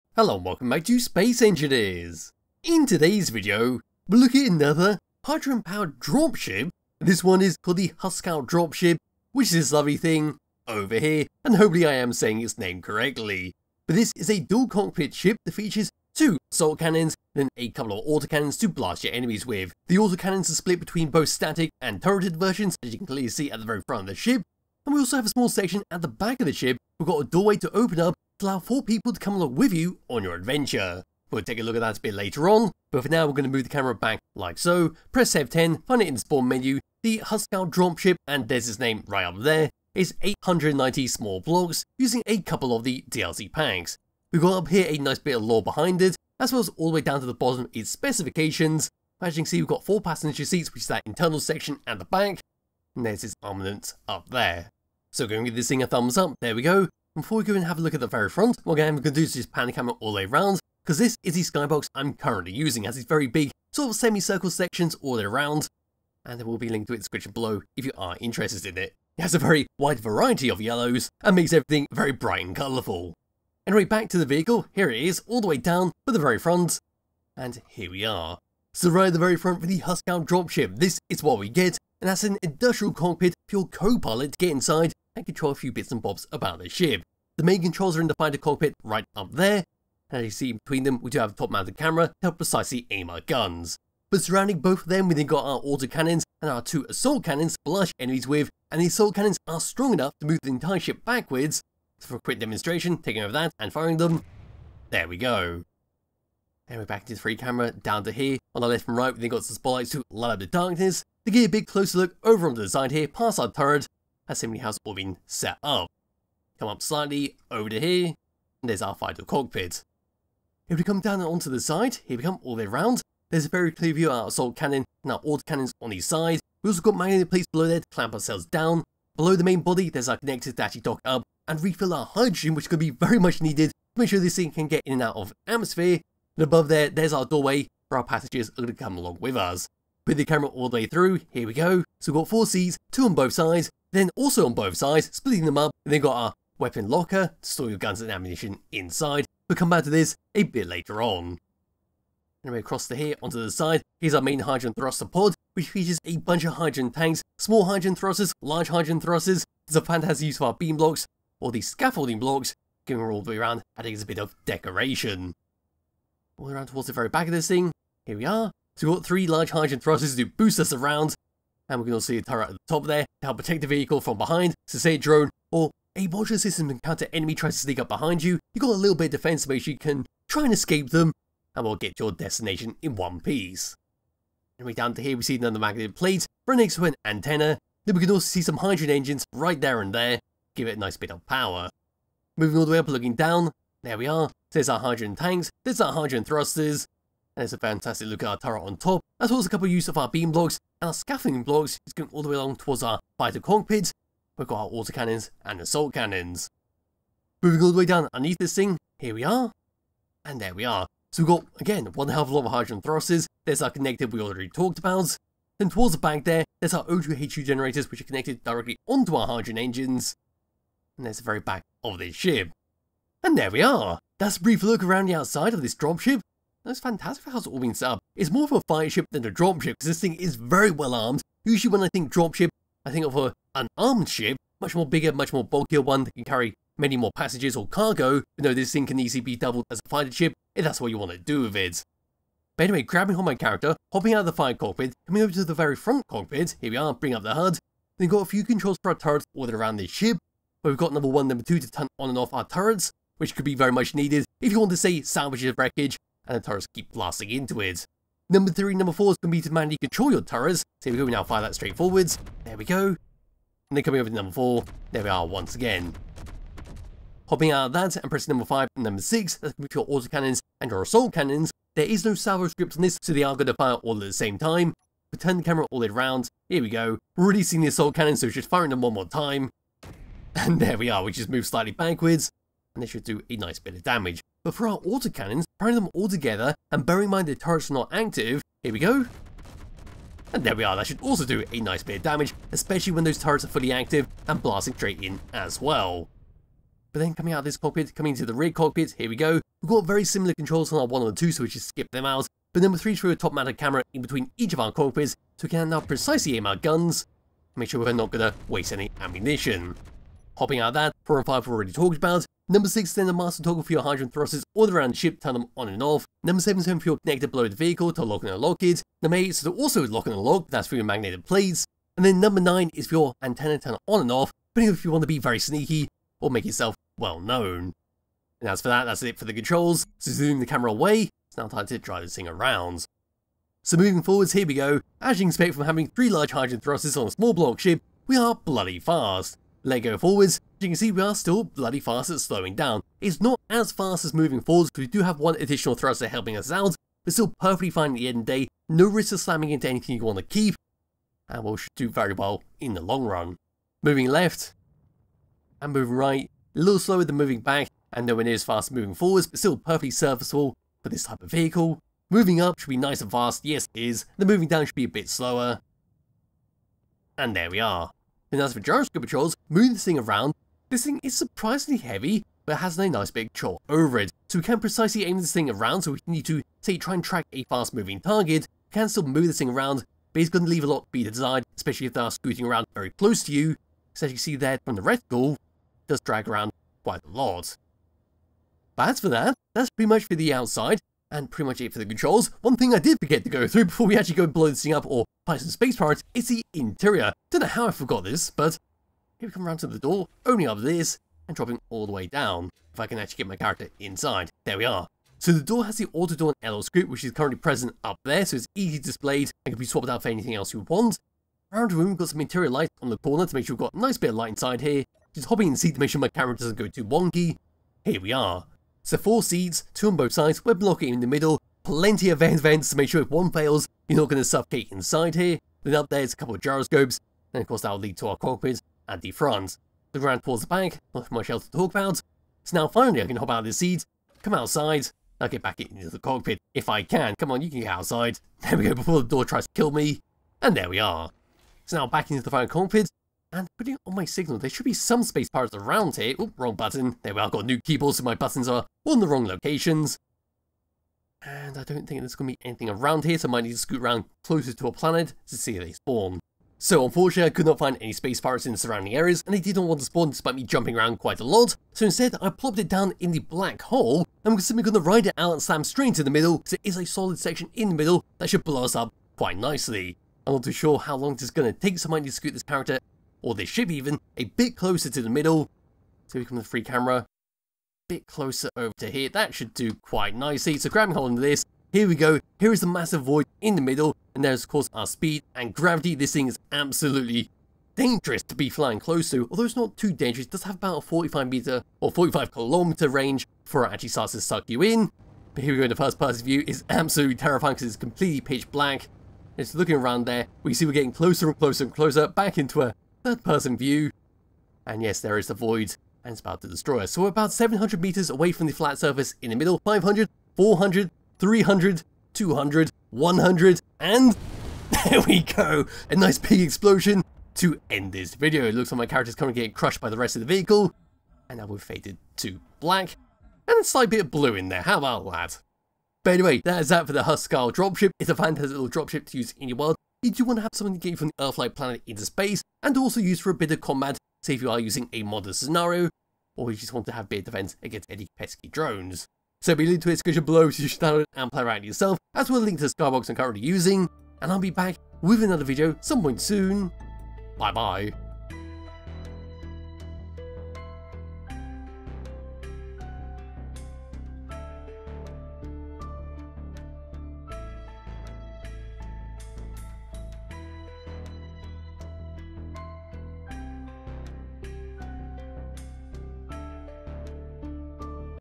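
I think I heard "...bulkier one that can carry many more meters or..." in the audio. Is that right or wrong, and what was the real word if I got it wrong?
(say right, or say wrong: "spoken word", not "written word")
wrong: "passengers", not "meters".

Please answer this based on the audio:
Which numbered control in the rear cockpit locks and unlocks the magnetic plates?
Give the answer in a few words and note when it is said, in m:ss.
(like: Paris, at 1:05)
8, at 5:19.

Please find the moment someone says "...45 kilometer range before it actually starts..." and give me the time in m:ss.
8:11.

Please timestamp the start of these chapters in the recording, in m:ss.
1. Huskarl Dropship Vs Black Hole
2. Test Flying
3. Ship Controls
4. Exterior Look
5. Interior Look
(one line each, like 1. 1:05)
1. 7:37
2. 5:30
3. 4:05
4. 1:19
5. 6:40.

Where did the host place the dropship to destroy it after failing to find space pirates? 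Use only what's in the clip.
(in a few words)
Black hole.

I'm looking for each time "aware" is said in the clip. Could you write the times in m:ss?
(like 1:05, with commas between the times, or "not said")
not said.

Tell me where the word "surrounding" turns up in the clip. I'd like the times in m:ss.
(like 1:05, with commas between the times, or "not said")
1:34, 7:38.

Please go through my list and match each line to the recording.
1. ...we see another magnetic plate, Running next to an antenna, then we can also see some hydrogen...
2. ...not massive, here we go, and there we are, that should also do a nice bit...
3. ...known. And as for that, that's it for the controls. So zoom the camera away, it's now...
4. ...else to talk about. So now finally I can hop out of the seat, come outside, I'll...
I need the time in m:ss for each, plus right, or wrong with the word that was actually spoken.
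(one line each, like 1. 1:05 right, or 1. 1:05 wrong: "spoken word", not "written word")
1. 3:05 right
2. 4:47 wrong: "active", not "massive"
3. 5:27 right
4. 7:11 right.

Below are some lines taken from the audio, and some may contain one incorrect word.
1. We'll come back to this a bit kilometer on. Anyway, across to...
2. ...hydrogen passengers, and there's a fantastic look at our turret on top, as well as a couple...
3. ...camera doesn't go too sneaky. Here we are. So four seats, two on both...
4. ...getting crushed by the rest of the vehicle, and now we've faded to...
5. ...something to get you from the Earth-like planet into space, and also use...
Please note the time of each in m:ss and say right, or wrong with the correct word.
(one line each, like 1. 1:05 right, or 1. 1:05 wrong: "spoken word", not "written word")
1. 2:29 wrong: "later", not "kilometer"
2. 3:15 wrong: "thrusters", not "passengers"
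3. 6:56 wrong: "wonky", not "sneaky"
4. 8:39 right
5. 8:50 right.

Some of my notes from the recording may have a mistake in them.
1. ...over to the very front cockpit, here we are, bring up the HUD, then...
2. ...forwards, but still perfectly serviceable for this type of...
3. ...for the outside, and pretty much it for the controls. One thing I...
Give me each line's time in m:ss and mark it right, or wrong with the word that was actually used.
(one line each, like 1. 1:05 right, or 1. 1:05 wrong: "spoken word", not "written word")
1. 4:05 right
2. 5:58 right
3. 6:30 right.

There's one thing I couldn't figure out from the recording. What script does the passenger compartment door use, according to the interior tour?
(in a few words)
Auto door and LL script.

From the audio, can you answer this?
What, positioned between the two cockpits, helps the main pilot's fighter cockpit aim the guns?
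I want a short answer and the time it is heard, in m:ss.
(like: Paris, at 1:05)
Top-mounted camera, at 1:31.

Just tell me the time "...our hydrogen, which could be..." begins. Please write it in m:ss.
2:11.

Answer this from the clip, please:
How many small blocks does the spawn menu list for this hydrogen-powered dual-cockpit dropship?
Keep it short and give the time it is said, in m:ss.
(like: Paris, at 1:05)
890, at 0:40.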